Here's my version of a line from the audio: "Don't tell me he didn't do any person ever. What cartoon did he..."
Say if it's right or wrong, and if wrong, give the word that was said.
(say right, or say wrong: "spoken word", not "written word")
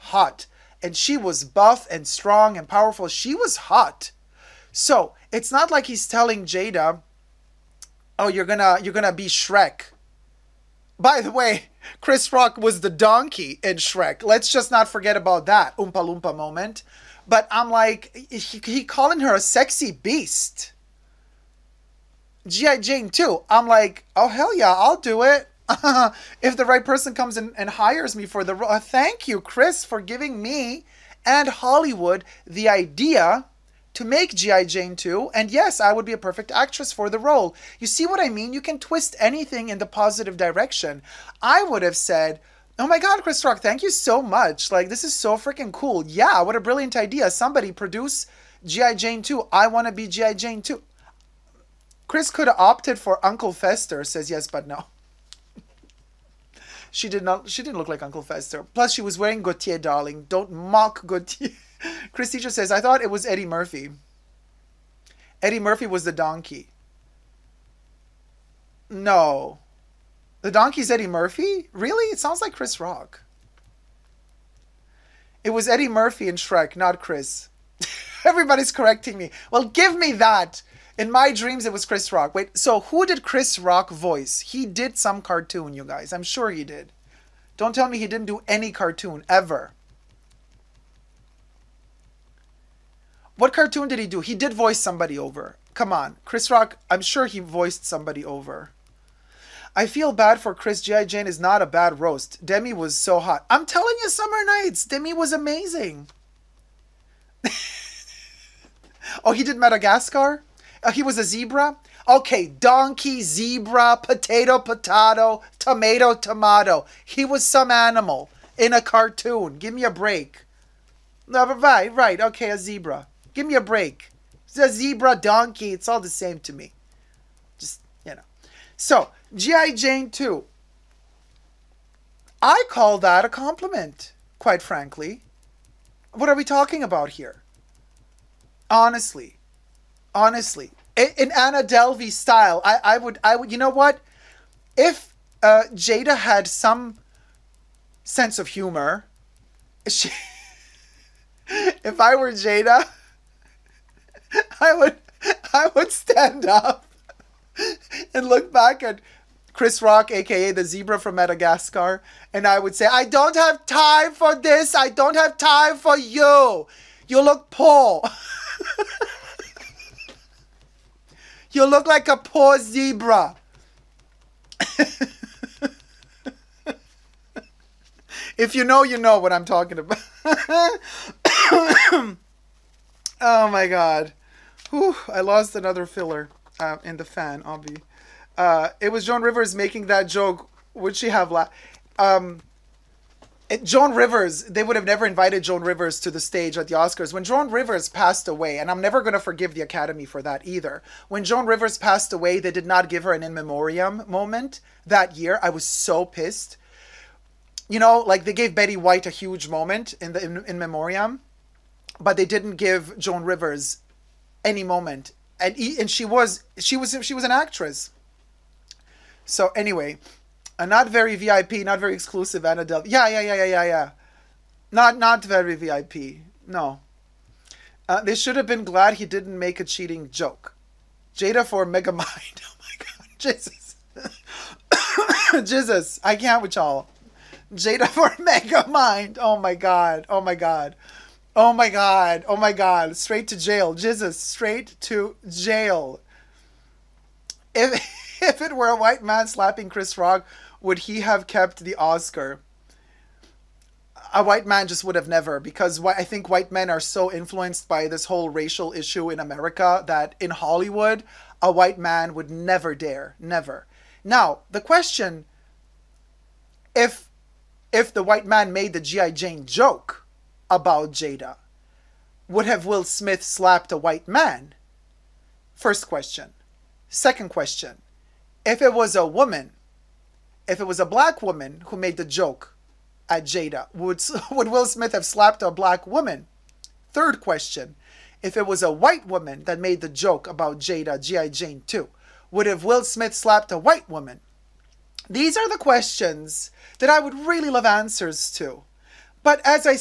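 wrong: "cartoon", not "person".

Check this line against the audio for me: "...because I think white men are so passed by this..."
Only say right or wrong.
wrong.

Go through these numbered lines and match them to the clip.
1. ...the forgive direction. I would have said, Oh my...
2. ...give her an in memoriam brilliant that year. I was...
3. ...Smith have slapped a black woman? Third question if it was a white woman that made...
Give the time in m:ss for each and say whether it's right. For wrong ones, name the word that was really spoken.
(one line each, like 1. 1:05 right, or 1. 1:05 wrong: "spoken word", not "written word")
1. 0:39 wrong: "positive", not "forgive"
2. 3:22 wrong: "moment", not "brilliant"
3. 4:44 right.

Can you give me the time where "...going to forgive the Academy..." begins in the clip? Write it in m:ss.
3:19.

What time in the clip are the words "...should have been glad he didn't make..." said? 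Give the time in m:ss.
3:48.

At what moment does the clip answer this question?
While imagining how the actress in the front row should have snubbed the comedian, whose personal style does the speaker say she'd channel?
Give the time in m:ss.
2:21.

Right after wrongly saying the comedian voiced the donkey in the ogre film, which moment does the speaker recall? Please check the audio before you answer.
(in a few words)
Oompa Loompa.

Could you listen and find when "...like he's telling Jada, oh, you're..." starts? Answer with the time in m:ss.
0:05.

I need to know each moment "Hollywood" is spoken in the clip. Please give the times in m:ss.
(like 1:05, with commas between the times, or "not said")
0:31, 4:20.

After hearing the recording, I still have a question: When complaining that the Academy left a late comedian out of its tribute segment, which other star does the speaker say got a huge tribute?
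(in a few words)
Betty White.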